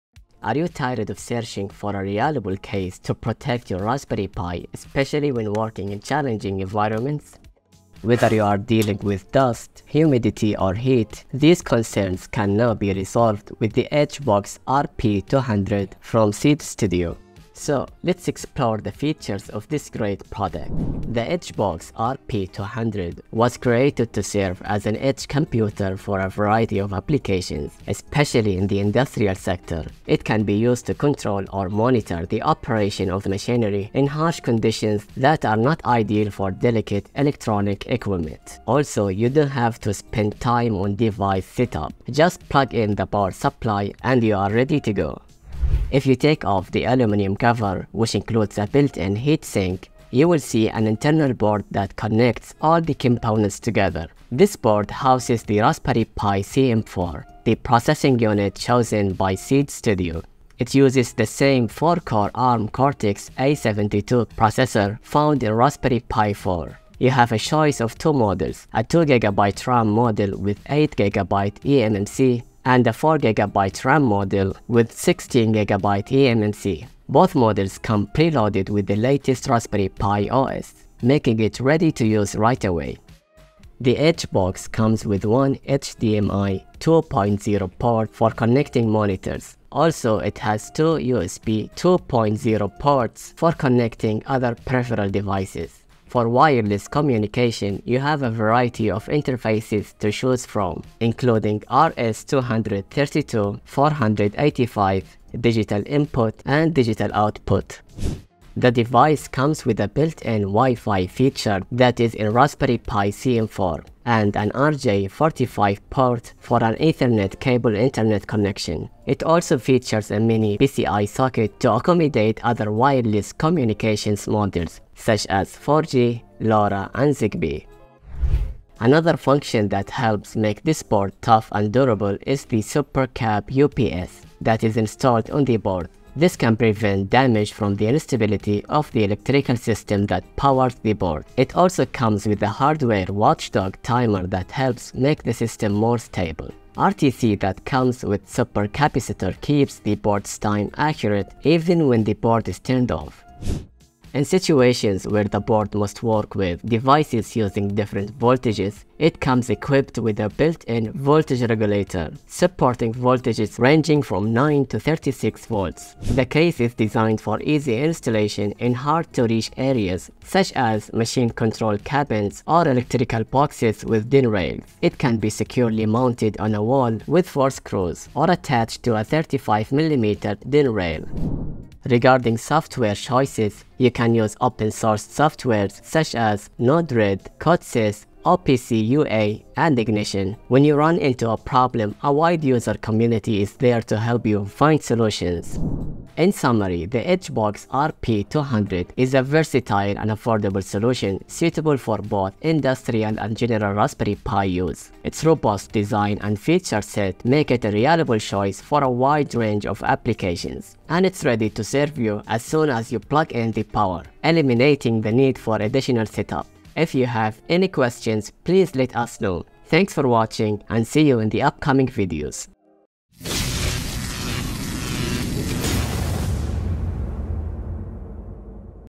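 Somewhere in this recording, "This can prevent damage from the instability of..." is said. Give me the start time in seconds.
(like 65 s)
136 s.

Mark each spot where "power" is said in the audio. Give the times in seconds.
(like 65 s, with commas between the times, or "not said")
43 s, 140 s, 213 s.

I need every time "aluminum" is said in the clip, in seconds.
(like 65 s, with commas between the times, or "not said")
46 s.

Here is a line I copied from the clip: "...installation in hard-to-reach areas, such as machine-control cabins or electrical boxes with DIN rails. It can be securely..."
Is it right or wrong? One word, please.
right.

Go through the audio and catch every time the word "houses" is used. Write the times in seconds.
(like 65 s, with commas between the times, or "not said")
54 s.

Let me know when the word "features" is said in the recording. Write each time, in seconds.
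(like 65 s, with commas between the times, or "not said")
18 s, 111 s, 119 s, 206 s.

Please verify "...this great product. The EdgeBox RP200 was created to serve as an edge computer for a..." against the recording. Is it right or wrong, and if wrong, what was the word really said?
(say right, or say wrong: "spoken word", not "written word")
right.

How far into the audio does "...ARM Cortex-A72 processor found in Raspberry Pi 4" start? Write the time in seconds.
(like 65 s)
62 s.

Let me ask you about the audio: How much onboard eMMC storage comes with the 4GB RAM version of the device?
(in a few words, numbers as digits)
16GB.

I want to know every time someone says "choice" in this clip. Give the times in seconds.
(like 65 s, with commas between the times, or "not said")
67 s, 182 s, 208 s.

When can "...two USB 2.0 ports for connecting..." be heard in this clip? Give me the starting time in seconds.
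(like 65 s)
90 s.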